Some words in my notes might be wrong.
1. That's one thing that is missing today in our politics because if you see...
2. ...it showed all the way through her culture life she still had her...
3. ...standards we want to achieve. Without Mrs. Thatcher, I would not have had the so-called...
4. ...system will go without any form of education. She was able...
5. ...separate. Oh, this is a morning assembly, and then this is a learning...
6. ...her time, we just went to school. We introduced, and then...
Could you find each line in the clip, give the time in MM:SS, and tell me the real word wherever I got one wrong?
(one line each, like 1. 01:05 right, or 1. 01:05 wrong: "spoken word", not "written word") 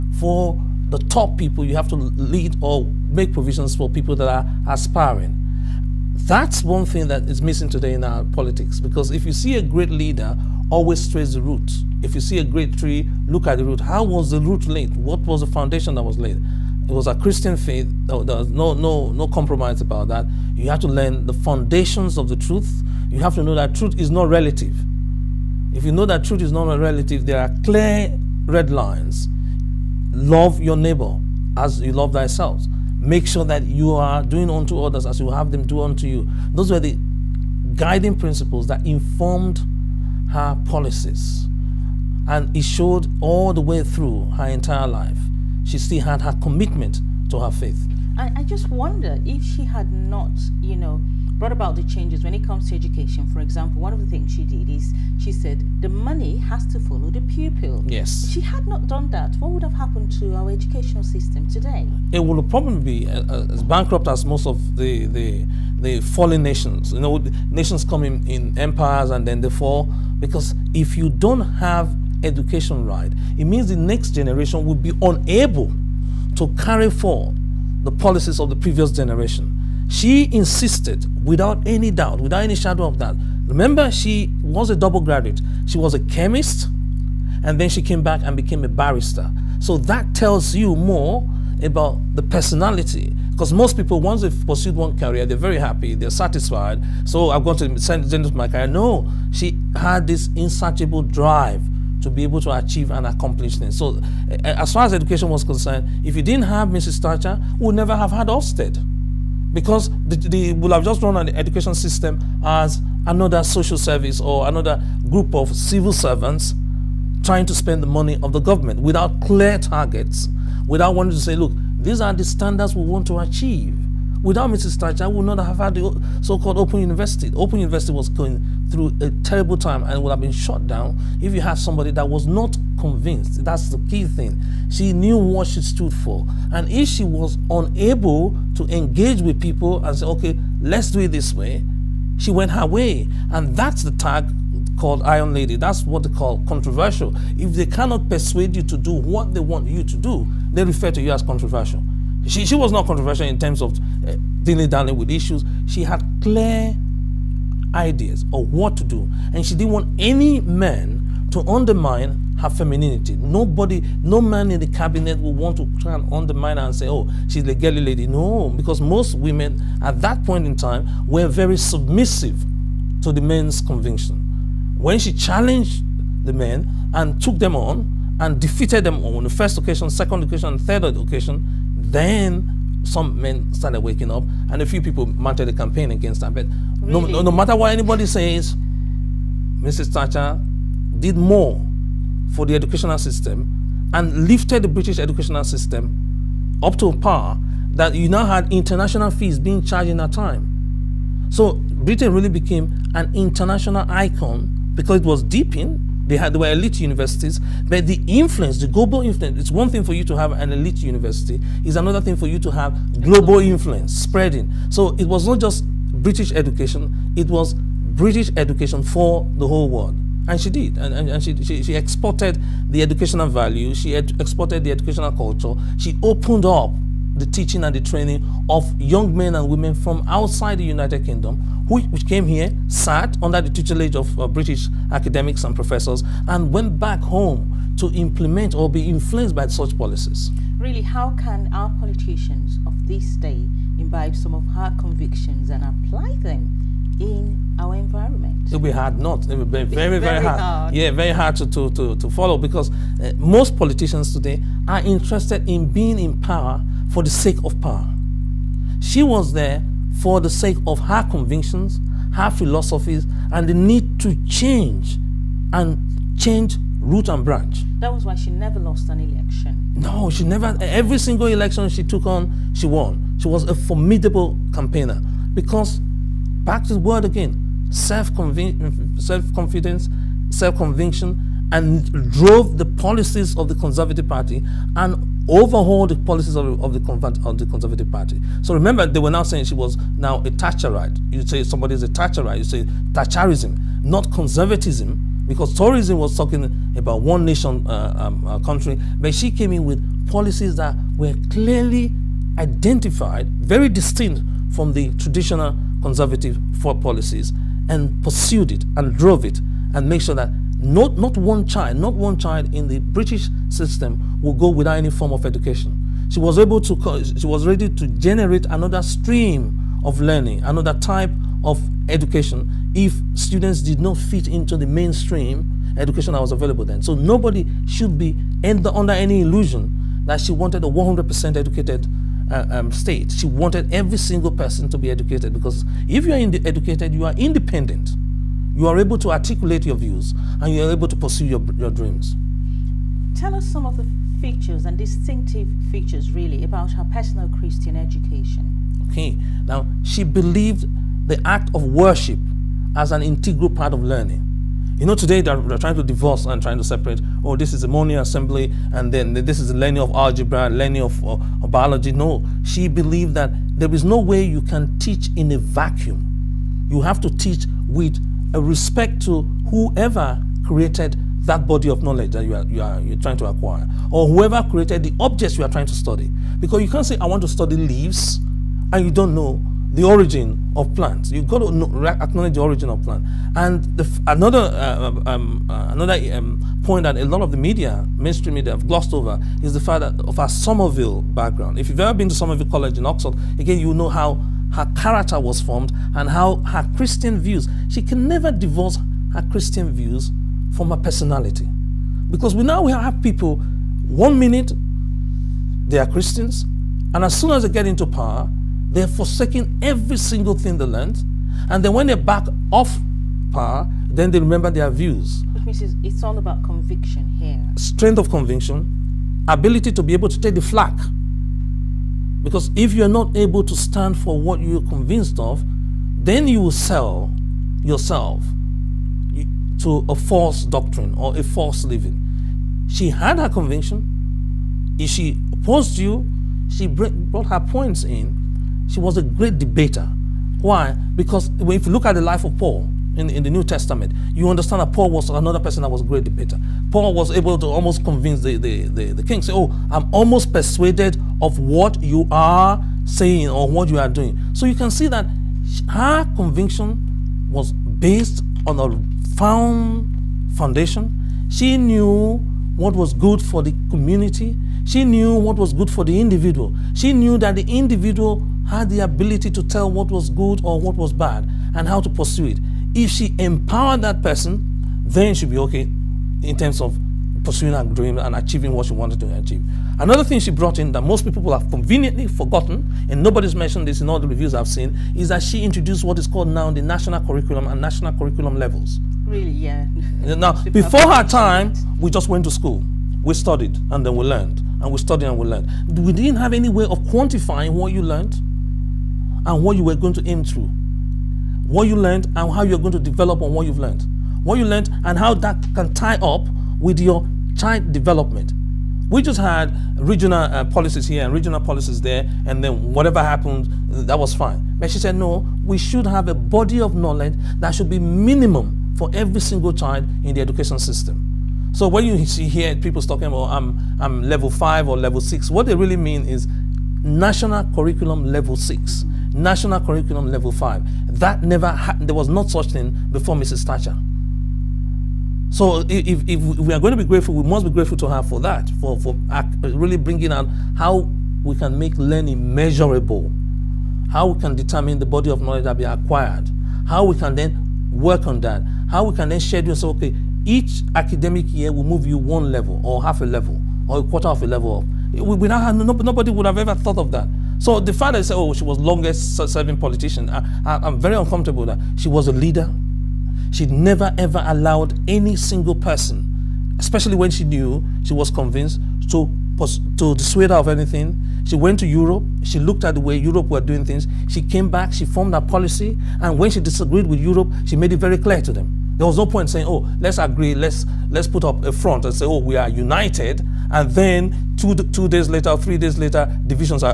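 1. 00:06 right
2. 00:42 wrong: "entire", not "culture"
3. 02:02 right
4. 05:13 right
5. 05:56 right
6. 08:10 wrong: "studied", not "introduced".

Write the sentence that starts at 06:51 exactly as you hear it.
And then when they back off power, then they remember their views.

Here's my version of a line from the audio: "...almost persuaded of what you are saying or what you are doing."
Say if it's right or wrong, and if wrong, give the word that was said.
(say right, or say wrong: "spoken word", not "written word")
right.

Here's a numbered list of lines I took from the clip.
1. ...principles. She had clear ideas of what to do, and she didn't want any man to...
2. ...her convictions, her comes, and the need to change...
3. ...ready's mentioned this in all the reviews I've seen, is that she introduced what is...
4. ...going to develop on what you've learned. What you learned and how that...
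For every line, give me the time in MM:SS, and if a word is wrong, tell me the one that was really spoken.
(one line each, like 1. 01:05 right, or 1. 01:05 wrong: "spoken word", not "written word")
1. 02:35 wrong: "issues", not "principles"
2. 04:20 wrong: "philosophies", not "comes"
3. 08:03 wrong: "nobody", not "ready"
4. 08:22 right.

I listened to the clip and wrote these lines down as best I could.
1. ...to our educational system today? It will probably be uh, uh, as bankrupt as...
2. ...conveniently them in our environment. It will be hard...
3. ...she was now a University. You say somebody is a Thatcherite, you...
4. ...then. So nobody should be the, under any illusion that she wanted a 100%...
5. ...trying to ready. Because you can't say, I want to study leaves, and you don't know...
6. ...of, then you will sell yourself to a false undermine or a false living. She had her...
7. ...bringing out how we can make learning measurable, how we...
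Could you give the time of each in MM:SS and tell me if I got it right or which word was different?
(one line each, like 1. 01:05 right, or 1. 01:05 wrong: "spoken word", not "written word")
1. 01:00 right
2. 04:05 wrong: "apply", not "conveniently"
3. 04:49 wrong: "Thatcherite", not "University"
4. 05:26 right
5. 06:15 wrong: "study", not "ready"
6. 07:05 wrong: "doctrine", not "undermine"
7. 08:59 right.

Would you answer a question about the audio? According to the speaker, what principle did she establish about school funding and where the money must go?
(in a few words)
The money has to follow the pupil.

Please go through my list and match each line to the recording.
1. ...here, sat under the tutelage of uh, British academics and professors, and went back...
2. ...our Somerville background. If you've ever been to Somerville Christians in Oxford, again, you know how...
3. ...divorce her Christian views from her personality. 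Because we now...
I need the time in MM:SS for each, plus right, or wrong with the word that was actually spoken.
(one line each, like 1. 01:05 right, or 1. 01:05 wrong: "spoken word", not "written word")
1. 03:52 right
2. 06:30 wrong: "College", not "Christians"
3. 06:38 right.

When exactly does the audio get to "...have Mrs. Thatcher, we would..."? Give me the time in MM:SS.
01:46.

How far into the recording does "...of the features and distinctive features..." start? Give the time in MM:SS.
05:43.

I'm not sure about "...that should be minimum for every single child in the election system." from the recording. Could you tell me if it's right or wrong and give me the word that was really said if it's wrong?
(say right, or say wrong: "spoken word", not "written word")
wrong: "education", not "election".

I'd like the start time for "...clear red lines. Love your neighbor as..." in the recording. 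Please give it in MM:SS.
00:27.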